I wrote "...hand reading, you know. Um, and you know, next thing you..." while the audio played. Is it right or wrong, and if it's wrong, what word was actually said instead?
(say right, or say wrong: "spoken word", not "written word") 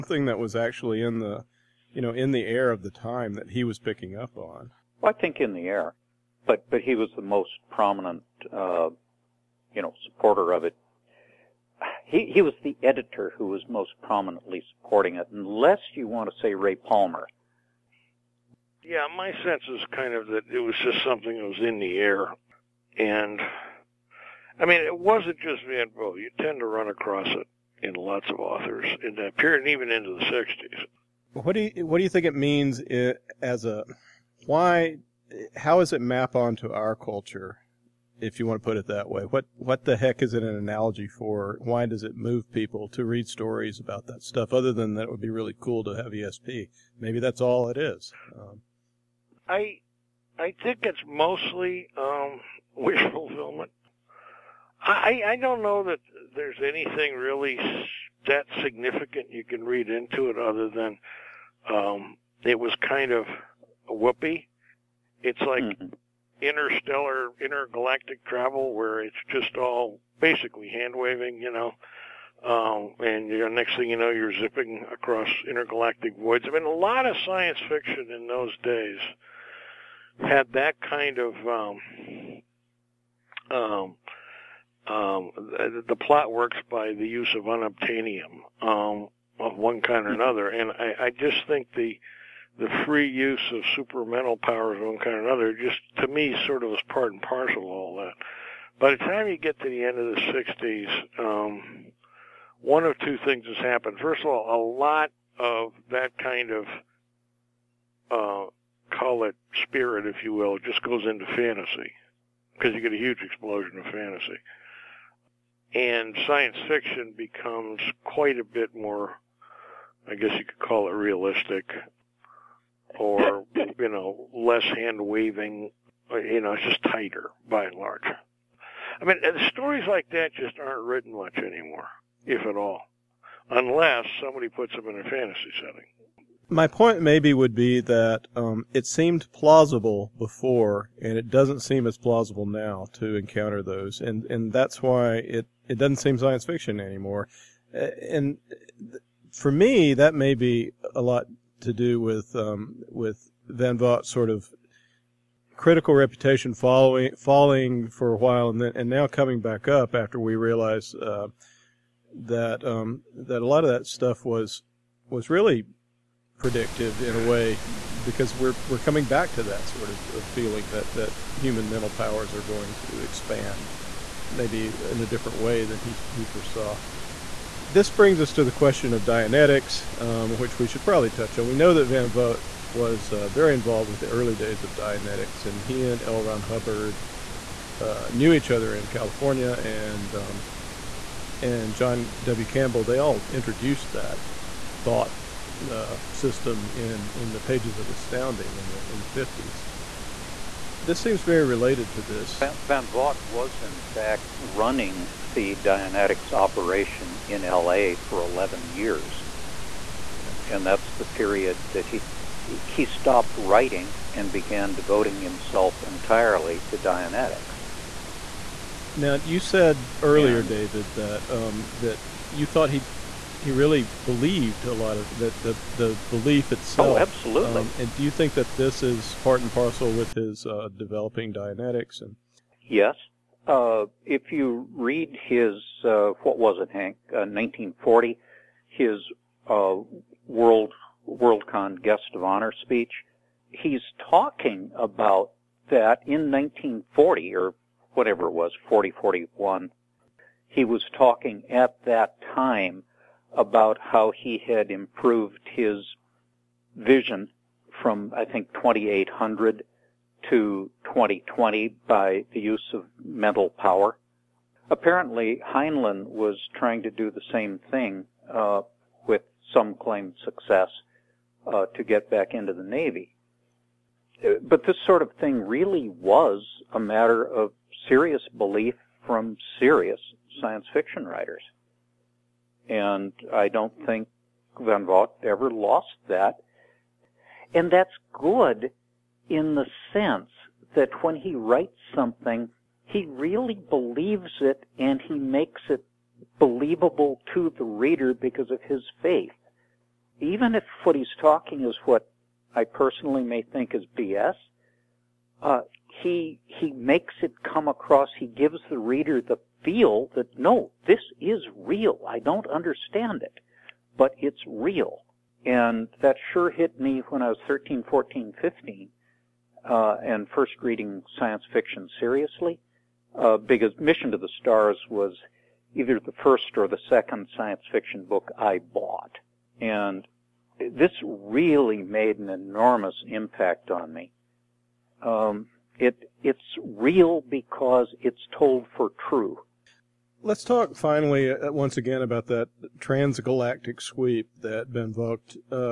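wrong: "waving", not "reading".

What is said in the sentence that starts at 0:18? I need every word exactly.
Yeah, my sense is kind of that it was just something that was in the air.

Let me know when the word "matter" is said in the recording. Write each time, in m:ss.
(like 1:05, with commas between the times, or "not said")
4:36.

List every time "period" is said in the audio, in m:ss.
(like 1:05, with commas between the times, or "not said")
0:29, 3:31.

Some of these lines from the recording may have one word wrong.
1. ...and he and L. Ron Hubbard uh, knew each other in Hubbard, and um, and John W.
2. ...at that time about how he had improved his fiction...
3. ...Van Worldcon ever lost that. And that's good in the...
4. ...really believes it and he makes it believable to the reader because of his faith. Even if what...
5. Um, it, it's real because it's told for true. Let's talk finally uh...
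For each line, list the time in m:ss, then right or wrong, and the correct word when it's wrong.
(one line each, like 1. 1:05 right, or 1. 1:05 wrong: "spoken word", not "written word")
1. 3:05 wrong: "California", not "Hubbard"
2. 4:11 wrong: "vision", not "fiction"
3. 4:44 wrong: "Vogt", not "Worldcon"
4. 4:53 right
5. 5:35 right.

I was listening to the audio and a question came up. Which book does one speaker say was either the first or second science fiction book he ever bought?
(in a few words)
Mission to the Stars.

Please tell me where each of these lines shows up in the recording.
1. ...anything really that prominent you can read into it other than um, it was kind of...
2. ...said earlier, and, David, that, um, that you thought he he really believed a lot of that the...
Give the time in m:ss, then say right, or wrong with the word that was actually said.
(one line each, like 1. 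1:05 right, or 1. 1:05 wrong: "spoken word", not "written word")
1. 0:56 wrong: "significant", not "prominent"
2. 3:39 right.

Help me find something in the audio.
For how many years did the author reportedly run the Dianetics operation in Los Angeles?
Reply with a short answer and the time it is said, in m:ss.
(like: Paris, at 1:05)
11, at 3:28.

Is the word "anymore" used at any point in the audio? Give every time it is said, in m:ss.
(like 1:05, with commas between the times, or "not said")
2:11, 2:26.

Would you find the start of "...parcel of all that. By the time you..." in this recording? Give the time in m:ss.
1:37.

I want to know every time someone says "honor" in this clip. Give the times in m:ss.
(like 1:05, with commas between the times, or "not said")
4:02.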